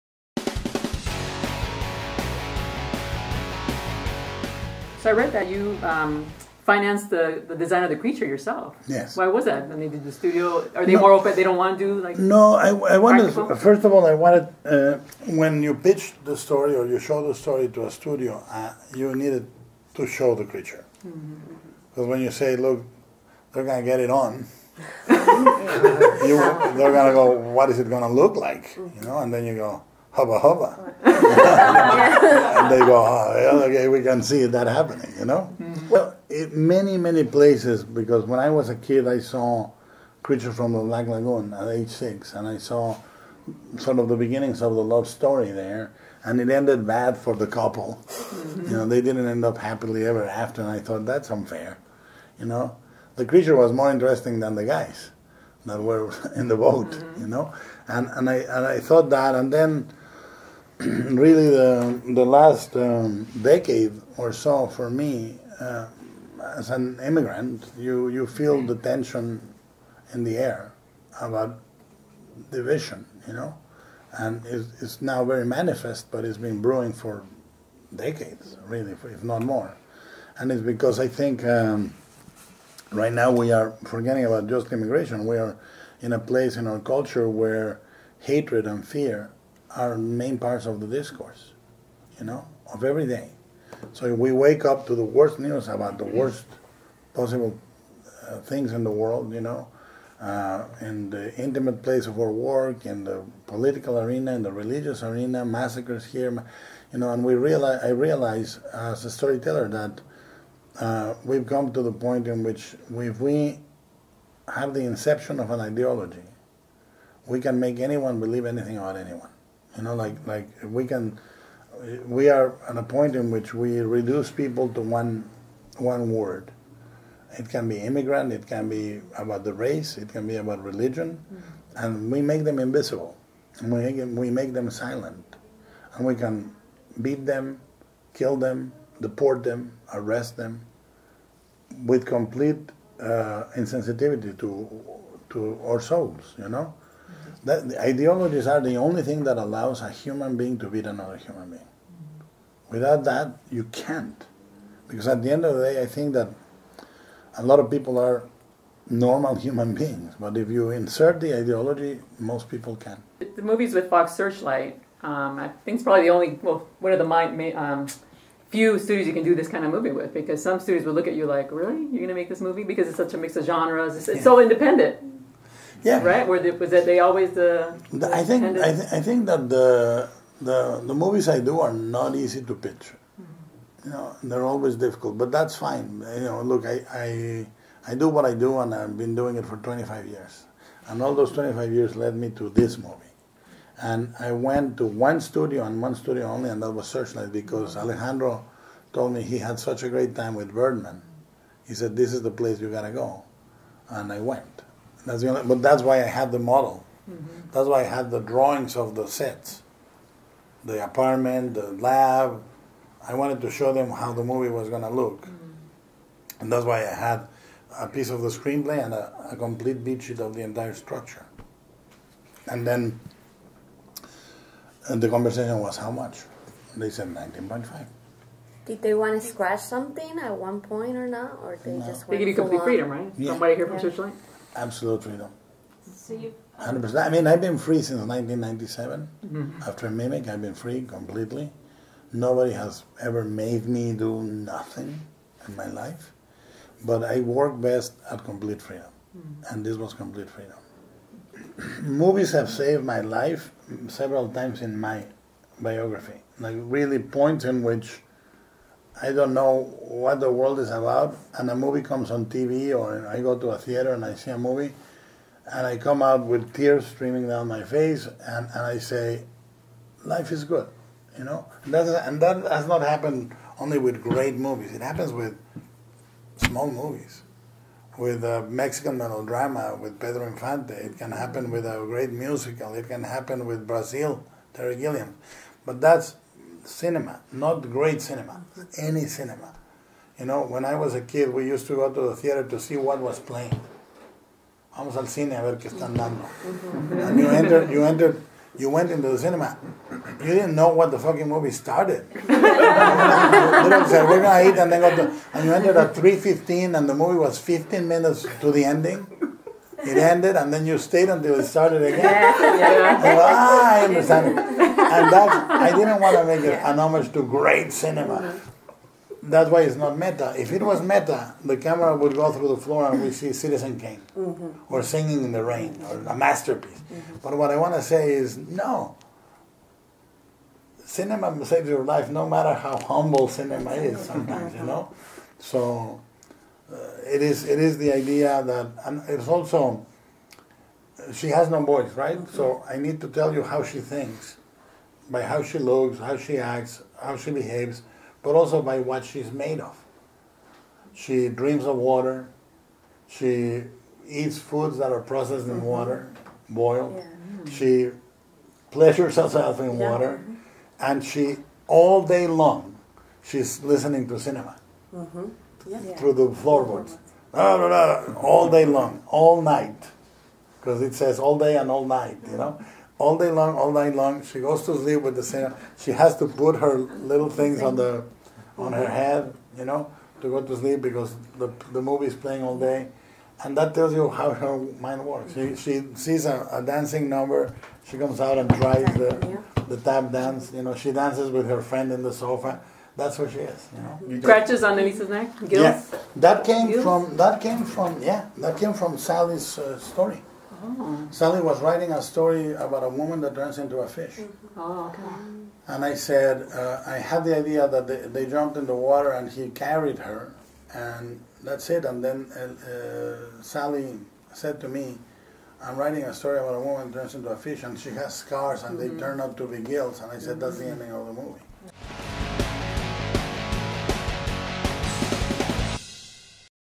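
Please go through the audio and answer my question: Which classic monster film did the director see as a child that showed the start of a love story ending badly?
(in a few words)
Creature from the Black Lagoon.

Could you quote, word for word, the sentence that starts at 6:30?
You know, she dances with her friend in the sofa.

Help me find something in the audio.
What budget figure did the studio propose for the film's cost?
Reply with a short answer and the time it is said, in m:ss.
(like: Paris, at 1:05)
19.5, at 3:47.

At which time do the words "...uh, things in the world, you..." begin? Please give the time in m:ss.
1:38.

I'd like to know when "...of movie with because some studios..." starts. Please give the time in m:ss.
2:49.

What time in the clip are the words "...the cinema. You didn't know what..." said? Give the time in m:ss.
4:59.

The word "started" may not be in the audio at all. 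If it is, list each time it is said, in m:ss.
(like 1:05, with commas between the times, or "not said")
5:01, 5:11.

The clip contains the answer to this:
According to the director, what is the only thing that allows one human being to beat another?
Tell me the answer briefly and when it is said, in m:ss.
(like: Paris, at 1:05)
Ideologies, at 2:27.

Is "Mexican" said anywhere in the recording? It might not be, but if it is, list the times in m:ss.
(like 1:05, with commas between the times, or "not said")
4:38.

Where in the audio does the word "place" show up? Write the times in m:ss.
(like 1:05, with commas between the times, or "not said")
0:37, 1:26, 1:41, 3:22.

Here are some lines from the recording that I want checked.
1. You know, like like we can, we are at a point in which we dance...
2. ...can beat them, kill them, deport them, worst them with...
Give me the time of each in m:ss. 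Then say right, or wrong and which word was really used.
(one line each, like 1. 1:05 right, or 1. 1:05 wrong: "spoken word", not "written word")
1. 1:59 wrong: "reduce", not "dance"
2. 2:16 wrong: "arrest", not "worst".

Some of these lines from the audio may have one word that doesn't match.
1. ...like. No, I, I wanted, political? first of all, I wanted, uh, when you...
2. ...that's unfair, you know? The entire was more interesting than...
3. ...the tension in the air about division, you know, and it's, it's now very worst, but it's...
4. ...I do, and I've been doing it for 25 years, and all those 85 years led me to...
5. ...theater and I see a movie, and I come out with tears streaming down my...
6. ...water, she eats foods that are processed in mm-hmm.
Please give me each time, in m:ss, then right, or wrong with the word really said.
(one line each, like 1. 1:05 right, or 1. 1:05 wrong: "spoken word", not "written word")
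1. 0:12 wrong: "practical", not "political"
2. 0:51 wrong: "creature", not "entire"
3. 1:08 wrong: "manifest", not "worst"
4. 3:08 wrong: "25", not "85"
5. 4:23 right
6. 5:51 right.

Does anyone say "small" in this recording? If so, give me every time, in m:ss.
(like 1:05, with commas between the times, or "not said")
4:36.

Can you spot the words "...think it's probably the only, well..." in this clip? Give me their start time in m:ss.
2:45.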